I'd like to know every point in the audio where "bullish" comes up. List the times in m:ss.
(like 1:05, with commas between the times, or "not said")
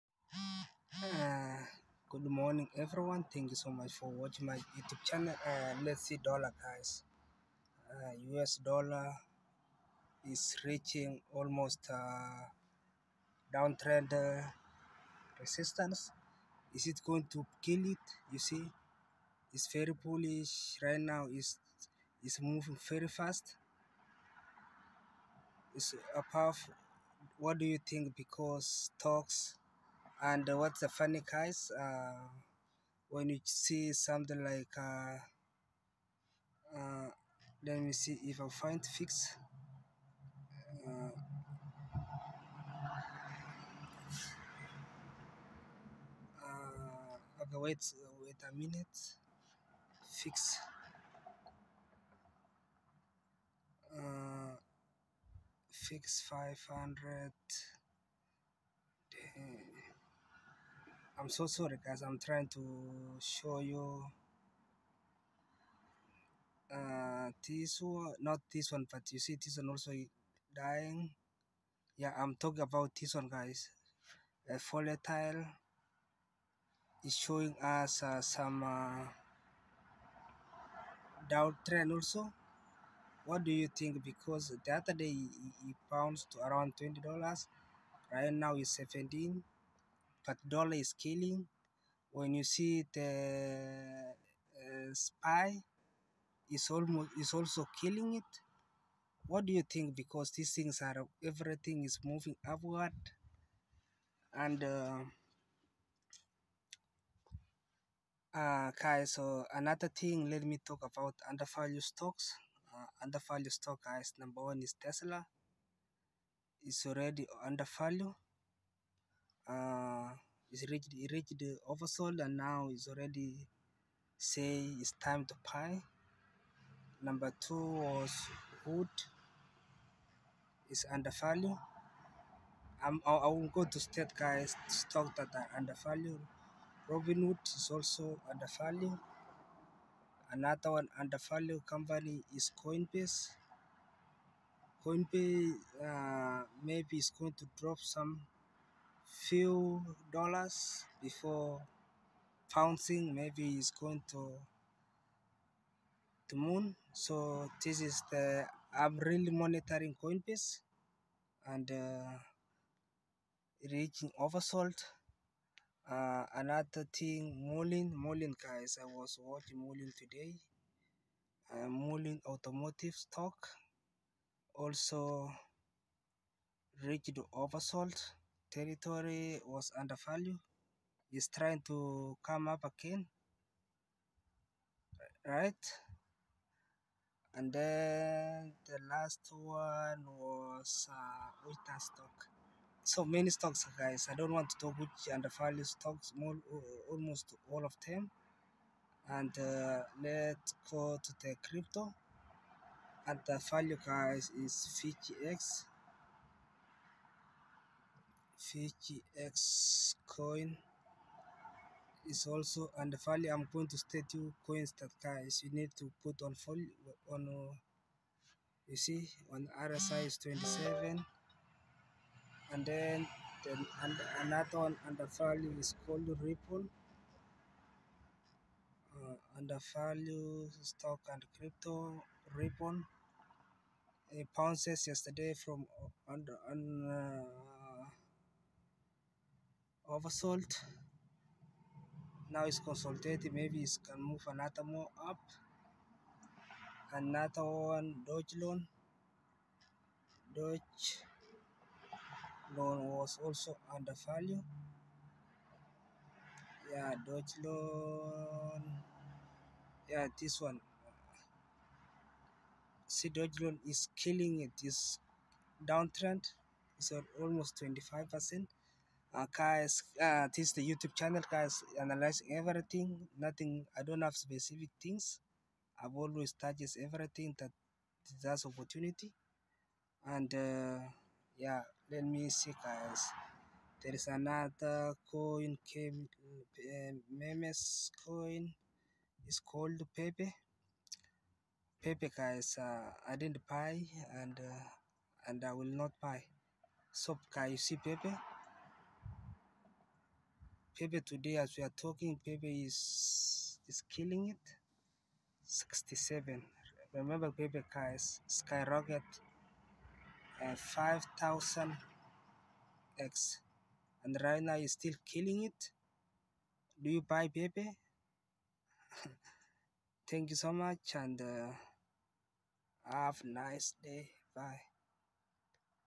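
0:20.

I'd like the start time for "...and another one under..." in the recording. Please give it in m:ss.
3:43.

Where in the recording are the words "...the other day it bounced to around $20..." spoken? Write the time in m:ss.
1:24.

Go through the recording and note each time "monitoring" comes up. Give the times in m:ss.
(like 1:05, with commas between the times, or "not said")
2:39.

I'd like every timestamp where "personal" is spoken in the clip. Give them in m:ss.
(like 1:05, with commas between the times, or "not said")
not said.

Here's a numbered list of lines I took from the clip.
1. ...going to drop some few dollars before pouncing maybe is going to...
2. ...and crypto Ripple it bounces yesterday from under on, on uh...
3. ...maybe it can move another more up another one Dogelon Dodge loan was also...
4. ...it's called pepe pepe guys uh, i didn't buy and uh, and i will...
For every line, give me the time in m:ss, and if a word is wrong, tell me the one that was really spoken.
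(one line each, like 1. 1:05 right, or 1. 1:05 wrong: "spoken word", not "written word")
1. 2:27 right
2. 3:51 right
3. 4:03 right
4. 4:49 right.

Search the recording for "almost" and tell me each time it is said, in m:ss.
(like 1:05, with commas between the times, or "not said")
0:11, 1:36, 3:16, 4:27.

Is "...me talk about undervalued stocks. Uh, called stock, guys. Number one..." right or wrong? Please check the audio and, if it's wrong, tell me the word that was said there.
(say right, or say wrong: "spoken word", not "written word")
wrong: "undervalued", not "called".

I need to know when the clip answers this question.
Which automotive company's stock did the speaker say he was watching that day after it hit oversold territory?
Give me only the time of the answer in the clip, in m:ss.
2:51.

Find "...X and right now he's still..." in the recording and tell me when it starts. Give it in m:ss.
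5:12.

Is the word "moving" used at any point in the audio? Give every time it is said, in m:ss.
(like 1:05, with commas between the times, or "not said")
0:22, 1:42.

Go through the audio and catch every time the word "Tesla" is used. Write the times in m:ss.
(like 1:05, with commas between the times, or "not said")
1:54.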